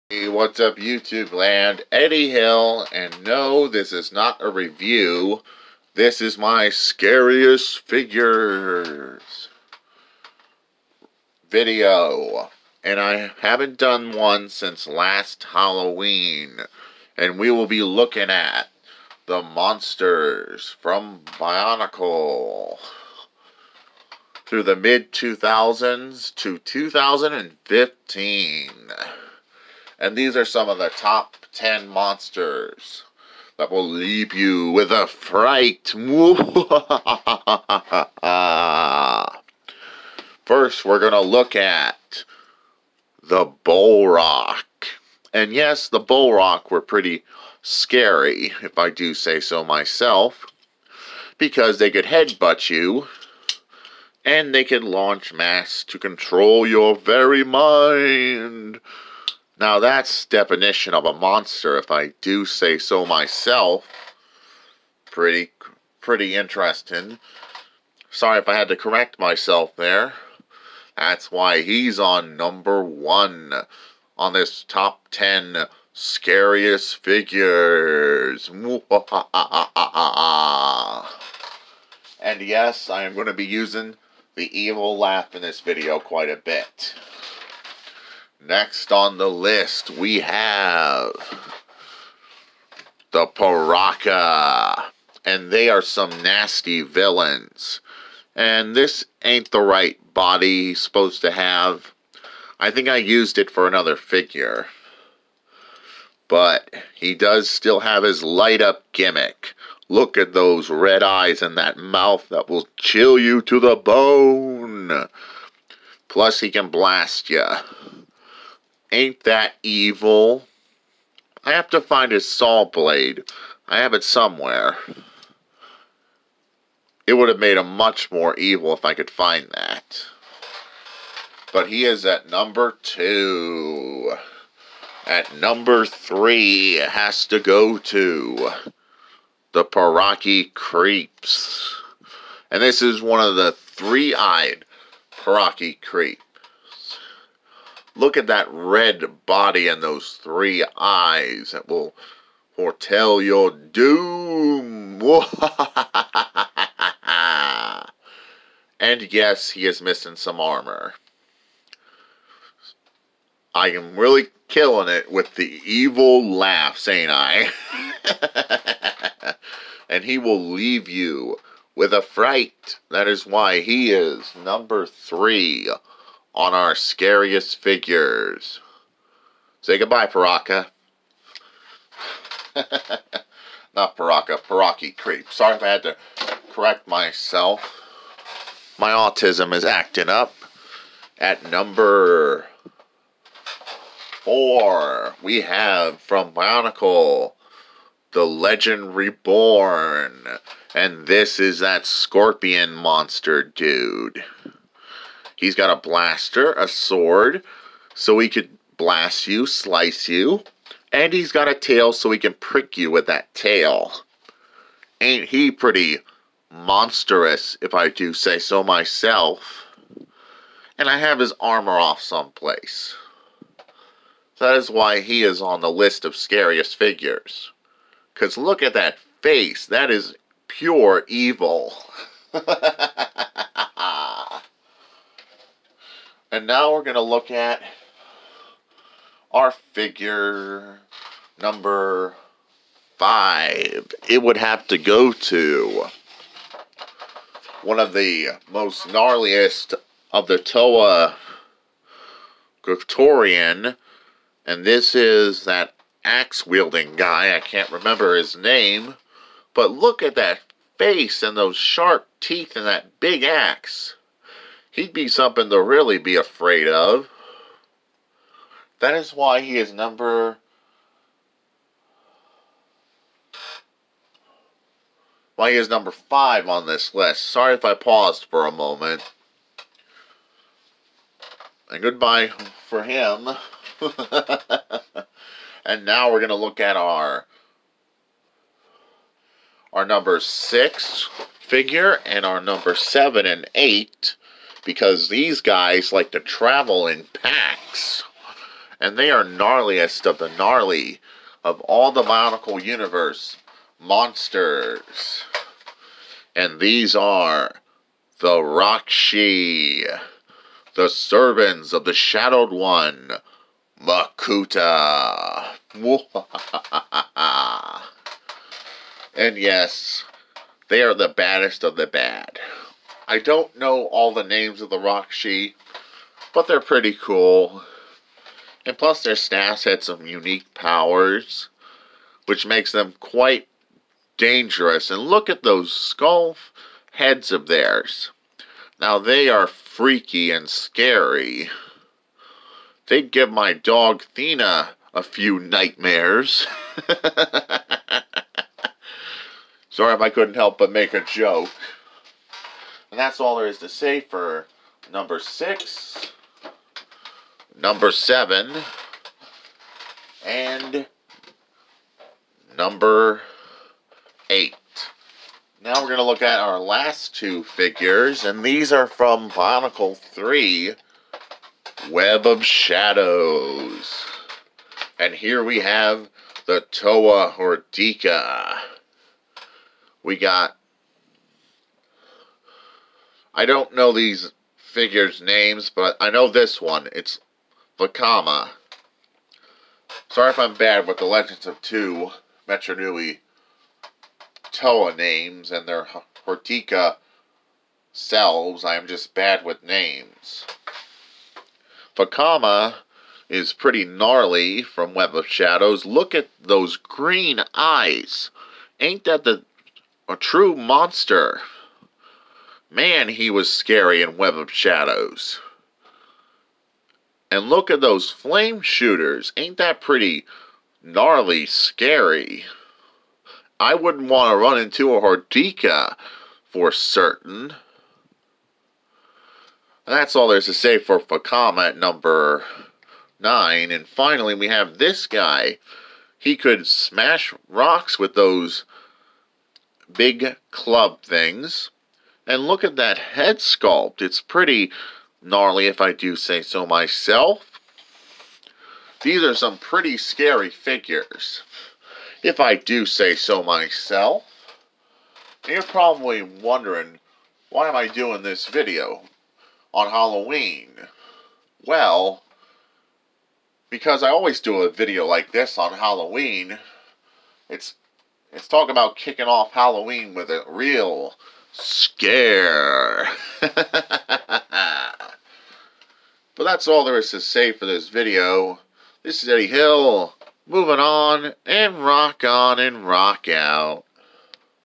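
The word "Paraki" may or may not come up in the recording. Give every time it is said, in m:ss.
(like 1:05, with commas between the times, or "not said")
2:19, 2:25, 3:04.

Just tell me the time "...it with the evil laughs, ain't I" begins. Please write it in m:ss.
2:44.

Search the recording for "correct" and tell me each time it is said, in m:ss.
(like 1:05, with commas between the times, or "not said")
1:08, 3:06.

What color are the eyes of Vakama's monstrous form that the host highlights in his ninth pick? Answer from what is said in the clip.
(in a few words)
green.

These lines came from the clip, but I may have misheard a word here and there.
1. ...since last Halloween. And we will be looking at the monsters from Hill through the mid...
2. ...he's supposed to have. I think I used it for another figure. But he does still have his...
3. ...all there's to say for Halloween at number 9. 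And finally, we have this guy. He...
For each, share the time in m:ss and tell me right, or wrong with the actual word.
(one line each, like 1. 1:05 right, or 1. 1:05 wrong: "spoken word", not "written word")
1. 0:14 wrong: "Bionicle", not "Hill"
2. 1:40 right
3. 7:10 wrong: "Vakama", not "Halloween".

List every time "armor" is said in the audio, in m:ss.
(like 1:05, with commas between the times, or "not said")
2:40, 3:41.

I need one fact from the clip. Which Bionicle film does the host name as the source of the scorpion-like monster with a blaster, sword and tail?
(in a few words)
The Legend Reborn.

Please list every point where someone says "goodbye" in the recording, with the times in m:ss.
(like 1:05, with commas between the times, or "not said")
2:59, 4:41.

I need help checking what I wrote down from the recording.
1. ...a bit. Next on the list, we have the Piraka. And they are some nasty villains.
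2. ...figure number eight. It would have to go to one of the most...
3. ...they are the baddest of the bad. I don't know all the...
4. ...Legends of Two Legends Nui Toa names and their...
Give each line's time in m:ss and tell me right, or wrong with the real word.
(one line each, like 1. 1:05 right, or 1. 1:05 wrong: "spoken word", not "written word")
1. 1:26 right
2. 3:59 wrong: "five", not "eight"
3. 5:20 right
4. 6:31 wrong: "Metru", not "Legends".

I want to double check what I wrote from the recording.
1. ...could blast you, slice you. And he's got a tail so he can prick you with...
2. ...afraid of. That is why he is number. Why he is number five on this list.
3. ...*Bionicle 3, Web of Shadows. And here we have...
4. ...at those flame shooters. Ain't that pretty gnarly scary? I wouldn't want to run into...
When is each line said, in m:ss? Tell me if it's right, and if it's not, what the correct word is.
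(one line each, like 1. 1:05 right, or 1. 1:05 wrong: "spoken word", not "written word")
1. 3:28 right
2. 4:26 right
3. 6:09 right
4. 6:57 right.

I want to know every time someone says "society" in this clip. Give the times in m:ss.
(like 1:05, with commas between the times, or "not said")
not said.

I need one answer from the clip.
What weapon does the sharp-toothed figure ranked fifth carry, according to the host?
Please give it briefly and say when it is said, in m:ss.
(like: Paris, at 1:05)
axe, at 4:23.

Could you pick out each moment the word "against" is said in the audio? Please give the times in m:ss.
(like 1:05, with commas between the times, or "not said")
not said.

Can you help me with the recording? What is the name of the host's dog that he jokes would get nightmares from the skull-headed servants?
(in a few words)
Thena.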